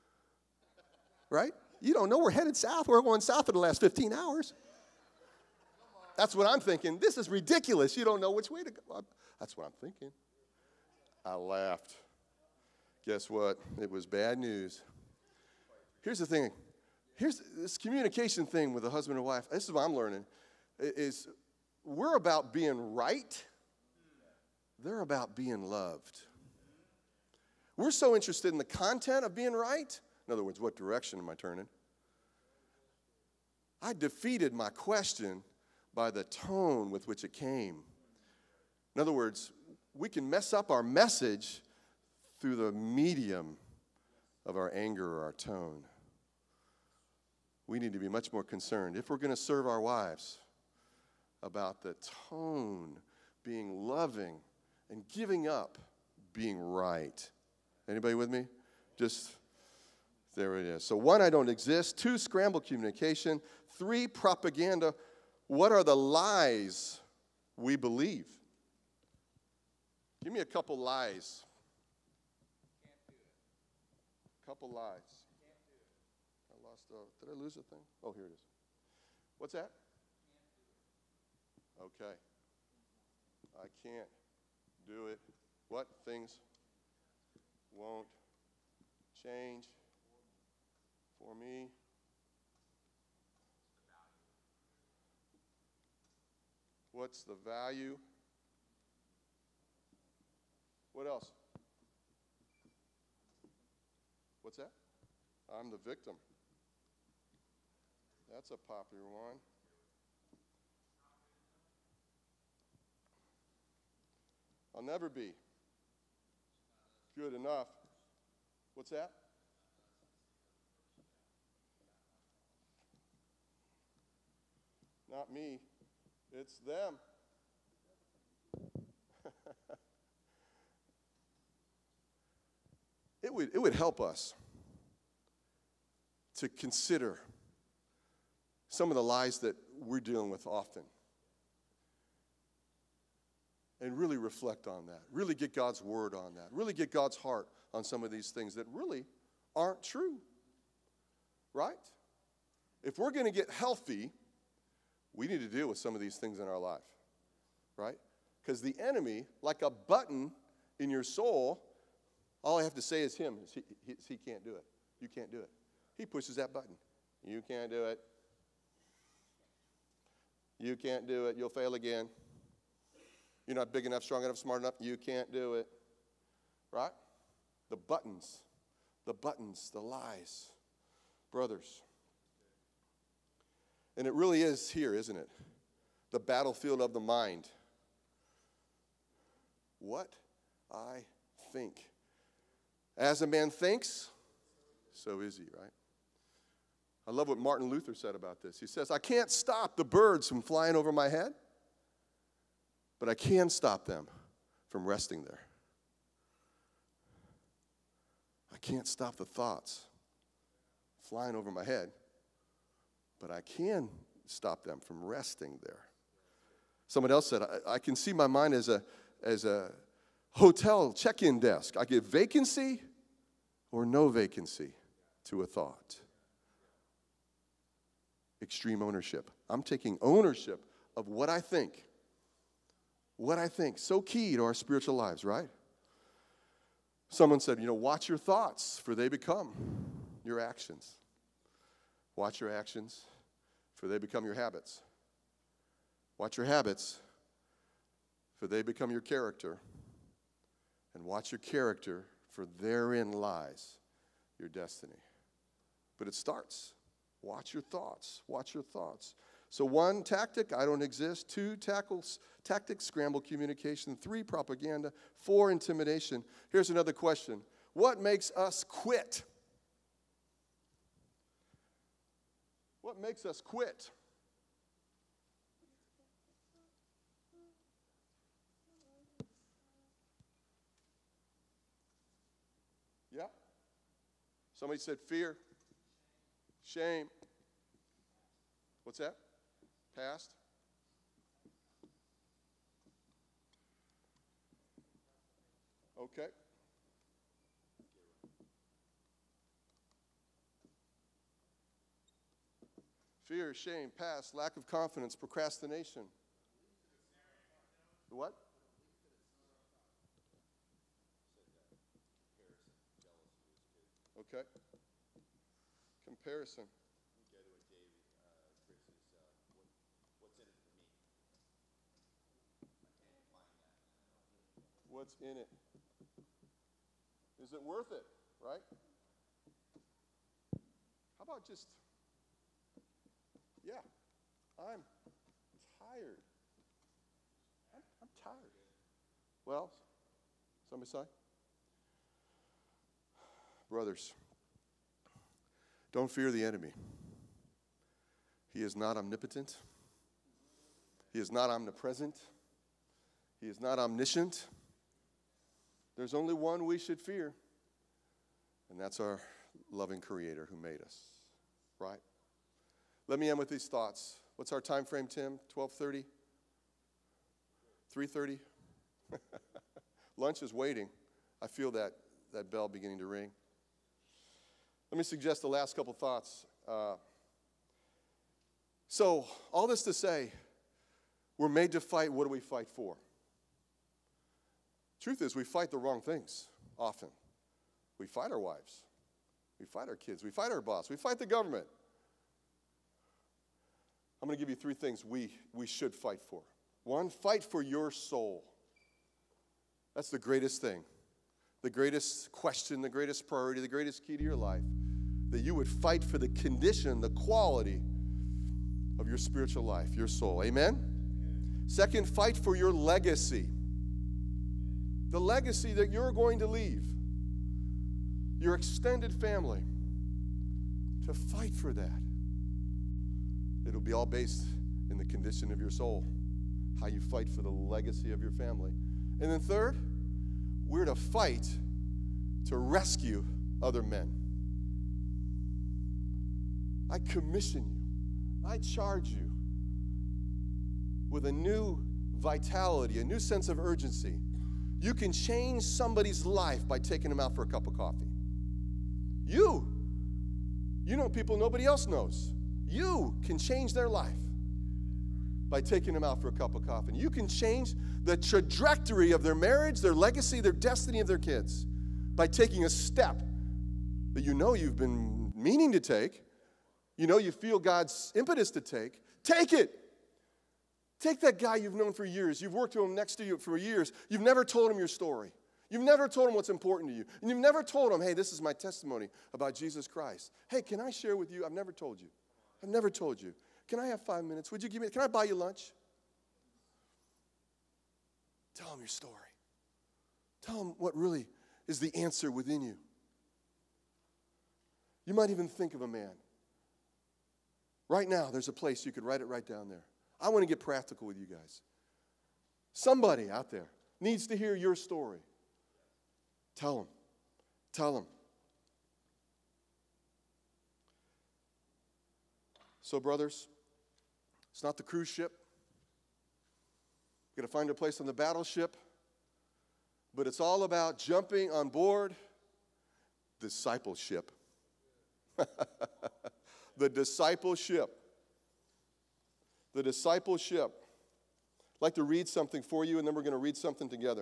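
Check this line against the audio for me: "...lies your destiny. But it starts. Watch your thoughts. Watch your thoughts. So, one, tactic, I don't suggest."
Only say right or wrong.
wrong.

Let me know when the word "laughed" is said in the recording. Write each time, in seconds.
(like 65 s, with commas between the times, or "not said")
11 s.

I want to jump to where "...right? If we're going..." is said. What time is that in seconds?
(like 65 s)
151 s.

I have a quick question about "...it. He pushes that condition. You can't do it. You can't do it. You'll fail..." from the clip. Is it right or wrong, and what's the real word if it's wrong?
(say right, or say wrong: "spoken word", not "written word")
wrong: "button", not "condition".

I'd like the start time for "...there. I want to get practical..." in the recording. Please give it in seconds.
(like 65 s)
499 s.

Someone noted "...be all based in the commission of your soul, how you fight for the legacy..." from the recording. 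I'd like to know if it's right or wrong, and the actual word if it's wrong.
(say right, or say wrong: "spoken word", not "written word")
wrong: "condition", not "commission".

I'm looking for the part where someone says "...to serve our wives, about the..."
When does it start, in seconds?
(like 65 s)
49 s.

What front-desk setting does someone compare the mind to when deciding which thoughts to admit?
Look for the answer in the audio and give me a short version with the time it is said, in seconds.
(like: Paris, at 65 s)
Hotel check in desk, at 220 s.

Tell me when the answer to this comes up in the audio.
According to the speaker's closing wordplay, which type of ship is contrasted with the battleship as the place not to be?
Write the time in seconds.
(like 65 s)
514 s.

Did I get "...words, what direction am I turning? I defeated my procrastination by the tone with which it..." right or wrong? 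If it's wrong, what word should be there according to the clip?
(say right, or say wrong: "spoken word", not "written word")
wrong: "question", not "procrastination".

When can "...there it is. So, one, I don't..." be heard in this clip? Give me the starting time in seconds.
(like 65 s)
60 s.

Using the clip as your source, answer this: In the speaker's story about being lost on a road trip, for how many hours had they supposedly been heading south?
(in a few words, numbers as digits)
15.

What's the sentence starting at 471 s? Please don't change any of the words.
Take that guy you've known for years, you've worked with him next to you for years, you've never told him your story.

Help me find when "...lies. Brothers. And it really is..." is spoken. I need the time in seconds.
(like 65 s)
179 s.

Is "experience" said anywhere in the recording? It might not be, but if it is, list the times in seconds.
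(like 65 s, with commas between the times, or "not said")
not said.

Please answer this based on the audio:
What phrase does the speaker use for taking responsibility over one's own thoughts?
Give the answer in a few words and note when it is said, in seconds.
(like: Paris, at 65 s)
Extreme ownership, at 228 s.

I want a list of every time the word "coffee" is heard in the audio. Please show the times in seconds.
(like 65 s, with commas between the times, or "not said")
447 s, 456 s.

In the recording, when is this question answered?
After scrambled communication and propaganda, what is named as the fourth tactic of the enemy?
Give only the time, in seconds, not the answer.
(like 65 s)
265 s.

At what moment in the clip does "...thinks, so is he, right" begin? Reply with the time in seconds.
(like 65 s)
193 s.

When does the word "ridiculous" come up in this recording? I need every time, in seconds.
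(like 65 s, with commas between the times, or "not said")
7 s.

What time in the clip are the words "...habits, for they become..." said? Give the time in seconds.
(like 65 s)
246 s.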